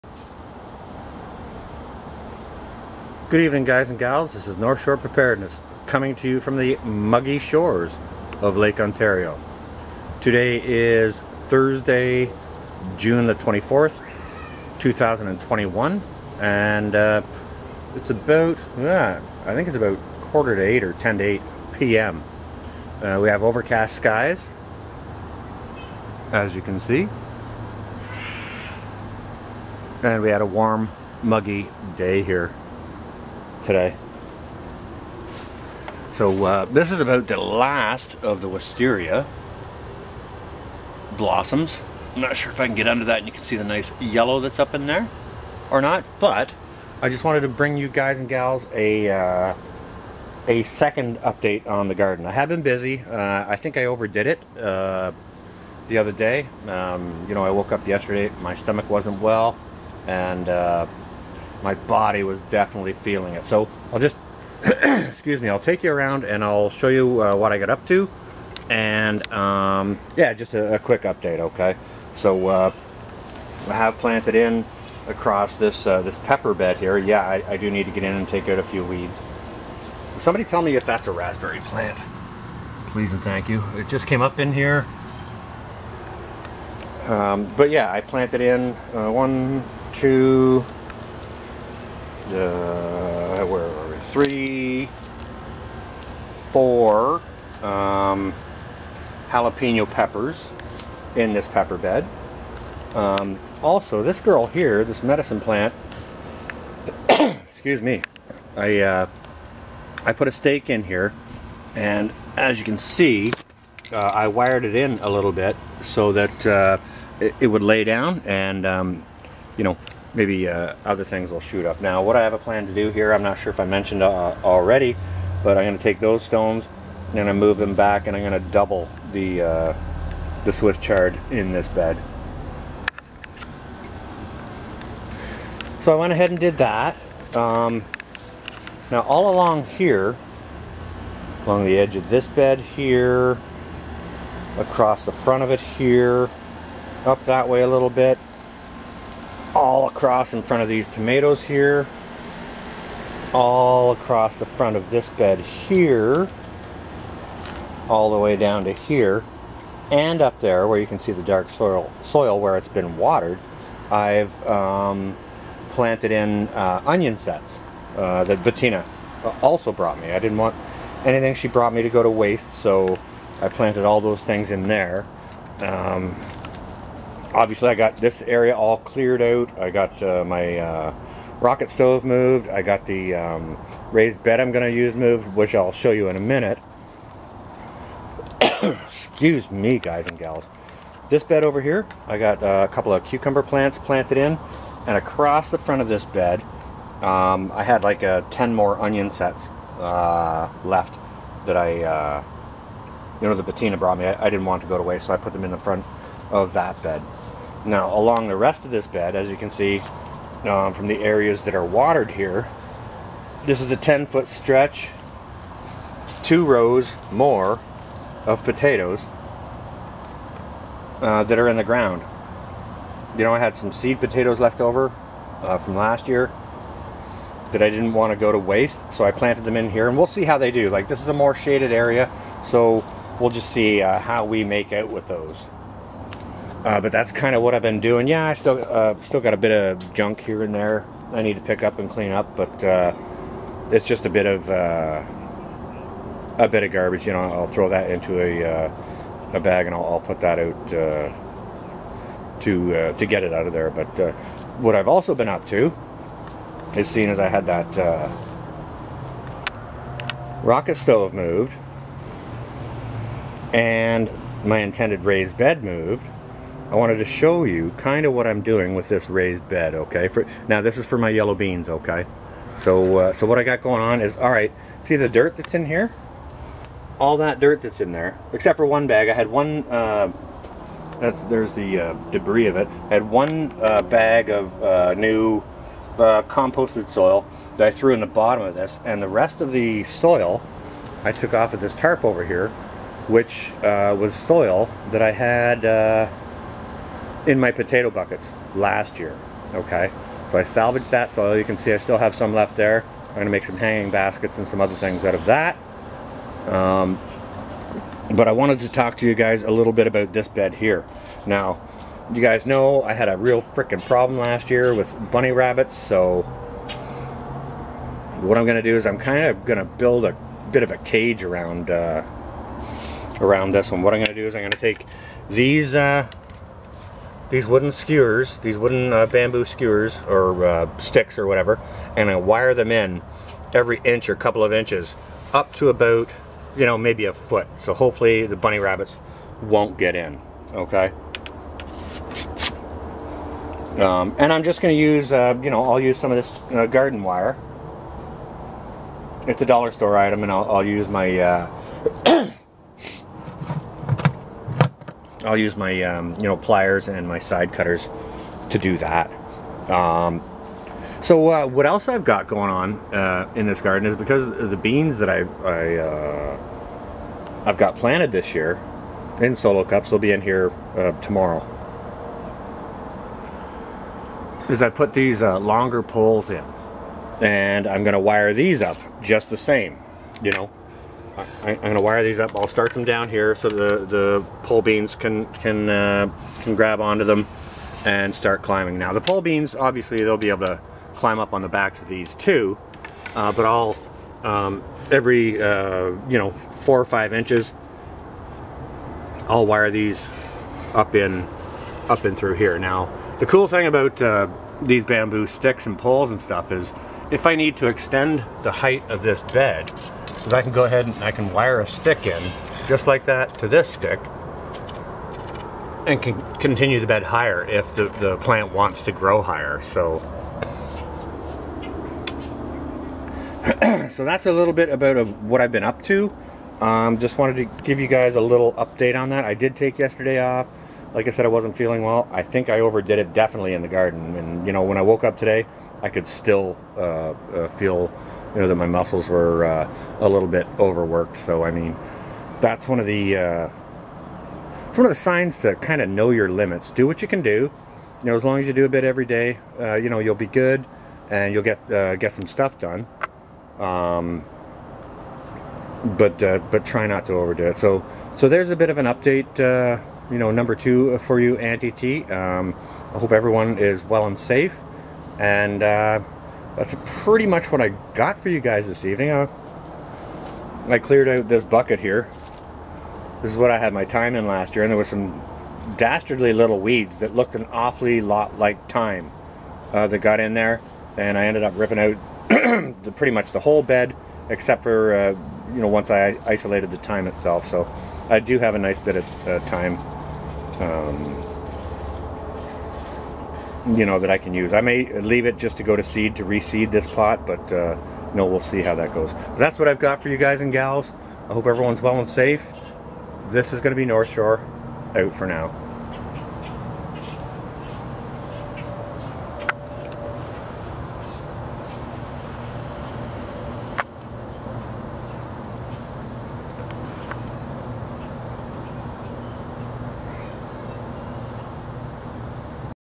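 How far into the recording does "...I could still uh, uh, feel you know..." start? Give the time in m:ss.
7:15.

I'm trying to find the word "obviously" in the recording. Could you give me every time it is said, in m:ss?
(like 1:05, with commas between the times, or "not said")
2:57, 6:29.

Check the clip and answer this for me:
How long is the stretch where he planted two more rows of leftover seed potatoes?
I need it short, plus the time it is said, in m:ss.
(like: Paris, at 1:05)
10 feet, at 3:33.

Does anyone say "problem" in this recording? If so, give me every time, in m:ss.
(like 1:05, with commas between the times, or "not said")
5:13.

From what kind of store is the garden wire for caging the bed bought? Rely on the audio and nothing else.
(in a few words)
Dollar store.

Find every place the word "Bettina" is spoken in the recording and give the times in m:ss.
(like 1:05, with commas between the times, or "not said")
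2:48, 3:23.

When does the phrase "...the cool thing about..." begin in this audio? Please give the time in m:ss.
6:43.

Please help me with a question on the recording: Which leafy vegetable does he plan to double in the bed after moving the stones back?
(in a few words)
Swiss chard.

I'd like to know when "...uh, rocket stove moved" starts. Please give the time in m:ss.
3:00.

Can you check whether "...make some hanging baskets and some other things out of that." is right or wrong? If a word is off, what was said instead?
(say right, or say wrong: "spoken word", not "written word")
right.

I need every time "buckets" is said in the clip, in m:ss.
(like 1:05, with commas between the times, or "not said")
4:57, 7:51.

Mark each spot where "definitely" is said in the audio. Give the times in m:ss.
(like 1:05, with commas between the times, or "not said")
1:02, 7:13.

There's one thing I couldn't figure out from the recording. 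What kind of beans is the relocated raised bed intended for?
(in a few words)
Yellow beans.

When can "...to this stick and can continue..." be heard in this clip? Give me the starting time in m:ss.
6:53.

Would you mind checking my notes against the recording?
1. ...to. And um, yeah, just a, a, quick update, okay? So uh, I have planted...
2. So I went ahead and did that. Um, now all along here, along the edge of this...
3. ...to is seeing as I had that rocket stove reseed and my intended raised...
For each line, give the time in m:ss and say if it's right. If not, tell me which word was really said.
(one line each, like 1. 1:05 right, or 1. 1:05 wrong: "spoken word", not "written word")
1. 1:07 right
2. 2:15 right
3. 4:15 wrong: "moved", not "reseed".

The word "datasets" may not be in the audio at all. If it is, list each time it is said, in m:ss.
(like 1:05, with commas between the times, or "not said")
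not said.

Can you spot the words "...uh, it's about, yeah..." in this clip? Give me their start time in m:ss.
0:16.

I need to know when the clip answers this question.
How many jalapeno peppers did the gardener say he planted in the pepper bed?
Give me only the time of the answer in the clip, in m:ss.
1:34.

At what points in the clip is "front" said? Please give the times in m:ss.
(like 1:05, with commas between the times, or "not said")
2:25, 2:30, 2:34, 3:15, 3:25.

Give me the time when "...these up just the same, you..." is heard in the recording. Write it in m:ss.
6:18.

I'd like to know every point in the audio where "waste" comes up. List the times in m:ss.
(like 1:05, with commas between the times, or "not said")
2:52, 3:24, 3:48.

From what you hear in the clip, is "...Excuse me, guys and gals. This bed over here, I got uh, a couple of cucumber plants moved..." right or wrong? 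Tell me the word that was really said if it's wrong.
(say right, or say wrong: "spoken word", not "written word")
wrong: "planted", not "moved".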